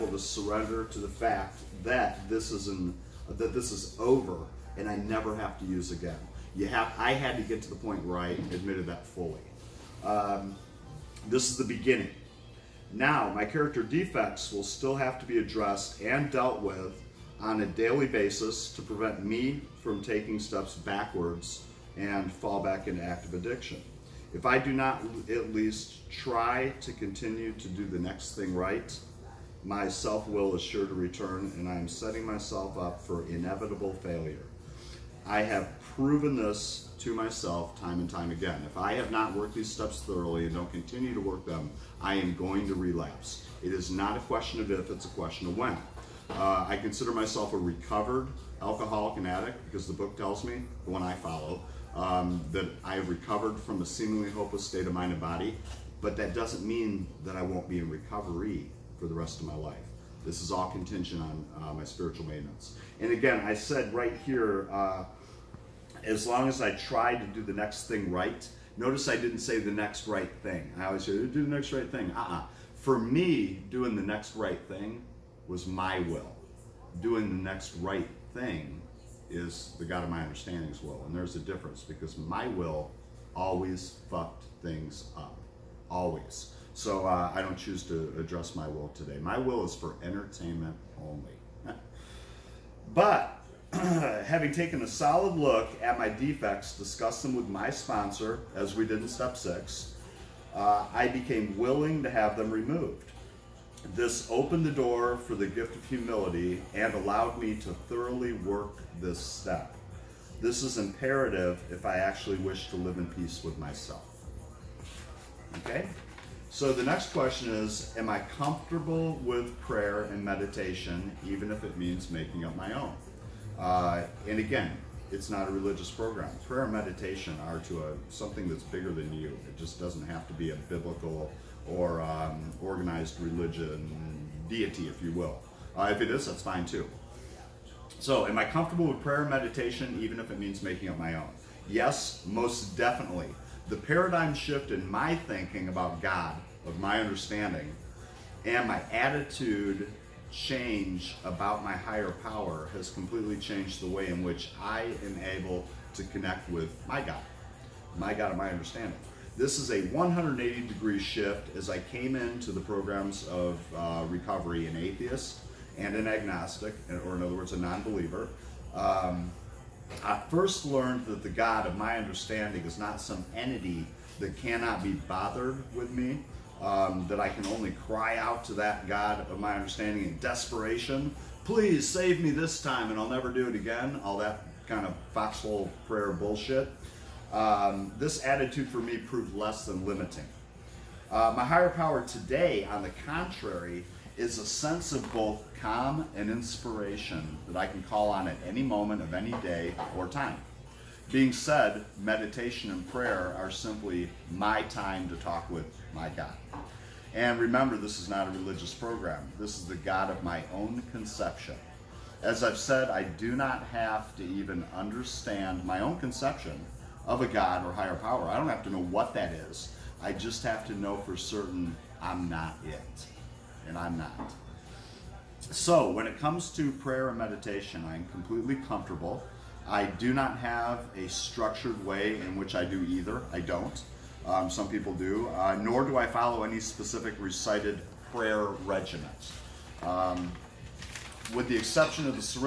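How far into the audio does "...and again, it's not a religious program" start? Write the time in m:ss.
2:04.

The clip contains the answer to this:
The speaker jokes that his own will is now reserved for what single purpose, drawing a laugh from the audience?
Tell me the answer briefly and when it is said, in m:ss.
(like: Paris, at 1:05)
entertainment, at 1:29.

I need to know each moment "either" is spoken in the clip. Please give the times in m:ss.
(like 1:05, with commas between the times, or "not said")
3:52.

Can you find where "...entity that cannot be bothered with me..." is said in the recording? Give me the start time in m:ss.
2:53.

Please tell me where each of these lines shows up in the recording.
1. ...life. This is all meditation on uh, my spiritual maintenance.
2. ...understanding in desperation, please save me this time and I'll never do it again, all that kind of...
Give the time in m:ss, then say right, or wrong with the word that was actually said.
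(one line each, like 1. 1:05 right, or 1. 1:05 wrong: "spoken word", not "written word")
1. 0:59 wrong: "contention", not "meditation"
2. 2:59 right.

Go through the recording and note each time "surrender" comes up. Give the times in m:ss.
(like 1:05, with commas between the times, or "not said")
0:00.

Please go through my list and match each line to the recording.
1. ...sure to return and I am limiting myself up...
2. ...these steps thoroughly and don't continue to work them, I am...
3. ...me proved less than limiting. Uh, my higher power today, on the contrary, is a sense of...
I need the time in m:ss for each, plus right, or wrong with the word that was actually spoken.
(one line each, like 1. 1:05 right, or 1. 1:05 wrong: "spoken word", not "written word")
1. 0:30 wrong: "setting", not "limiting"
2. 0:39 right
3. 3:08 right.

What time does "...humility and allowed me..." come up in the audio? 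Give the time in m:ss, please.
1:45.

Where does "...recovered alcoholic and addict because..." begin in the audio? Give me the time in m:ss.
0:47.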